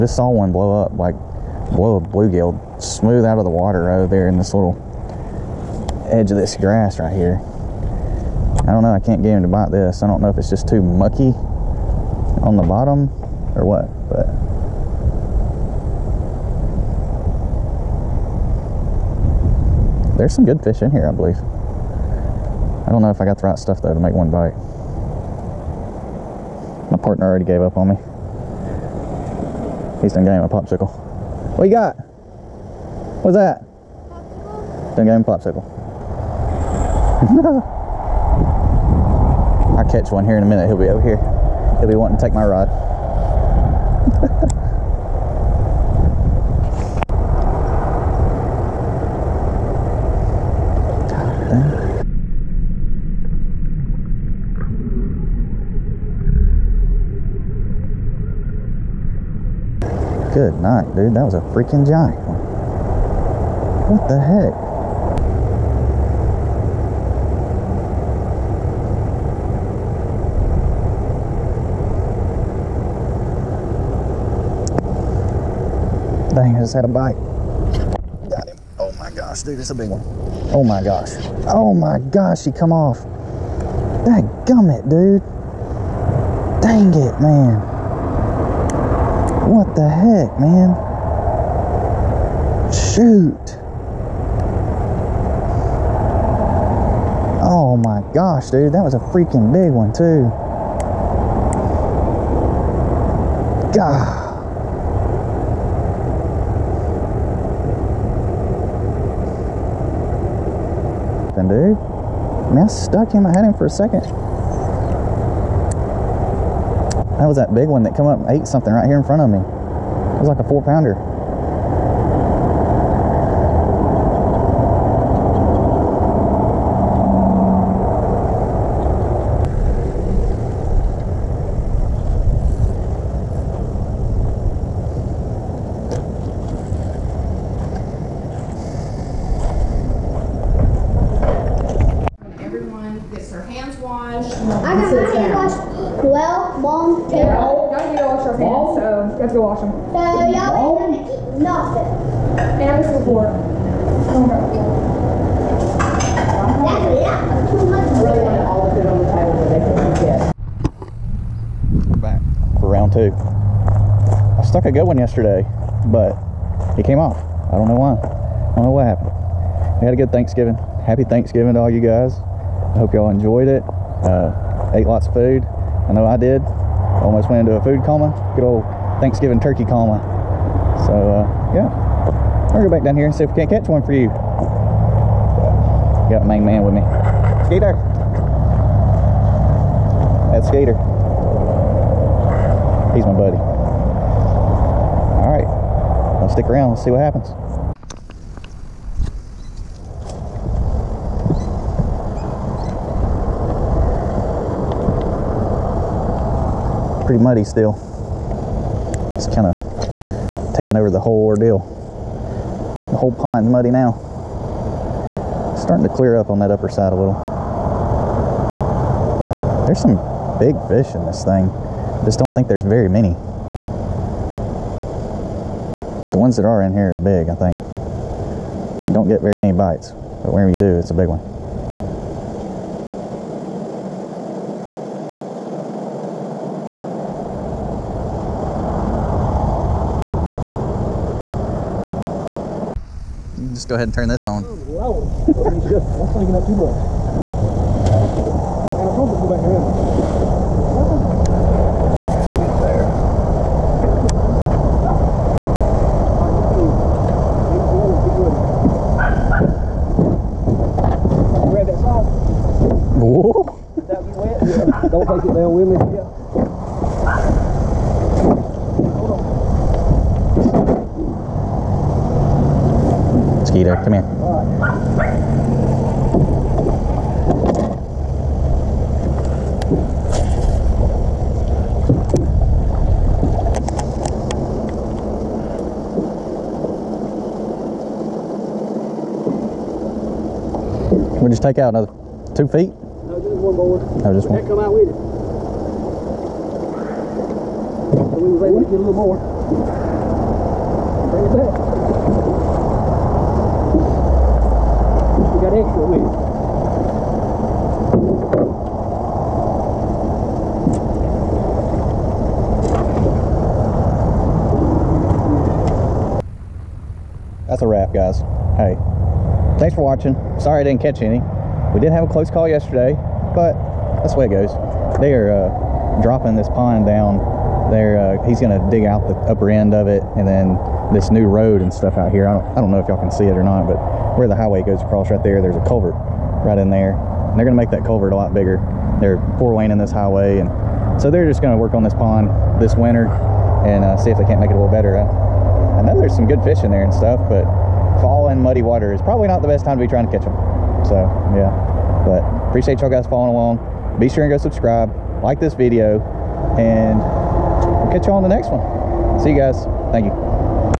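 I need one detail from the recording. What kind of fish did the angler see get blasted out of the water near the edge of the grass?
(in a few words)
bluegill.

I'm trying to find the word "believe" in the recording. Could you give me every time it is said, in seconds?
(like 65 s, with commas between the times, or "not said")
21 s.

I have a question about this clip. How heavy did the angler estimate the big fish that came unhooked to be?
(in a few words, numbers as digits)
4 pounds.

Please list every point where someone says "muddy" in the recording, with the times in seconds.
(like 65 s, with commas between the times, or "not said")
207 s, 213 s, 348 s.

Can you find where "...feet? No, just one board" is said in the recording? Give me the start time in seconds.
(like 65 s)
292 s.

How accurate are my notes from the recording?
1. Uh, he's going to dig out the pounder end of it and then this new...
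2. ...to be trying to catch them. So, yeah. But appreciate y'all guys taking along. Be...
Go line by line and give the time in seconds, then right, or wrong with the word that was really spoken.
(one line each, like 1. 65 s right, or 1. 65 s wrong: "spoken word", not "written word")
1. 328 s wrong: "upper", not "pounder"
2. 349 s wrong: "following", not "taking".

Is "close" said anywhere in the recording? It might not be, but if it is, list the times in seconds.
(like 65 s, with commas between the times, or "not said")
322 s.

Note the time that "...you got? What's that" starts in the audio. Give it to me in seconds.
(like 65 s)
31 s.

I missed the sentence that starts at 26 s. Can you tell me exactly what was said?
My partner already gave up on me.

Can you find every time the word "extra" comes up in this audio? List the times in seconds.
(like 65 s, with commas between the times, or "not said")
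305 s.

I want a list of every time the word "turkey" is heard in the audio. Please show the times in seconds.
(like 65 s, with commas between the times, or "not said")
179 s.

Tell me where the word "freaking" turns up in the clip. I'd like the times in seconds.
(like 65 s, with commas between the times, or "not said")
61 s, 98 s.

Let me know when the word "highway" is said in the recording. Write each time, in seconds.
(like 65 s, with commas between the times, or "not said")
334 s, 339 s.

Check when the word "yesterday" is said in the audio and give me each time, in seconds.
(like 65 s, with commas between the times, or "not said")
164 s, 322 s.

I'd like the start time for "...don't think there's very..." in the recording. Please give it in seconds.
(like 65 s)
222 s.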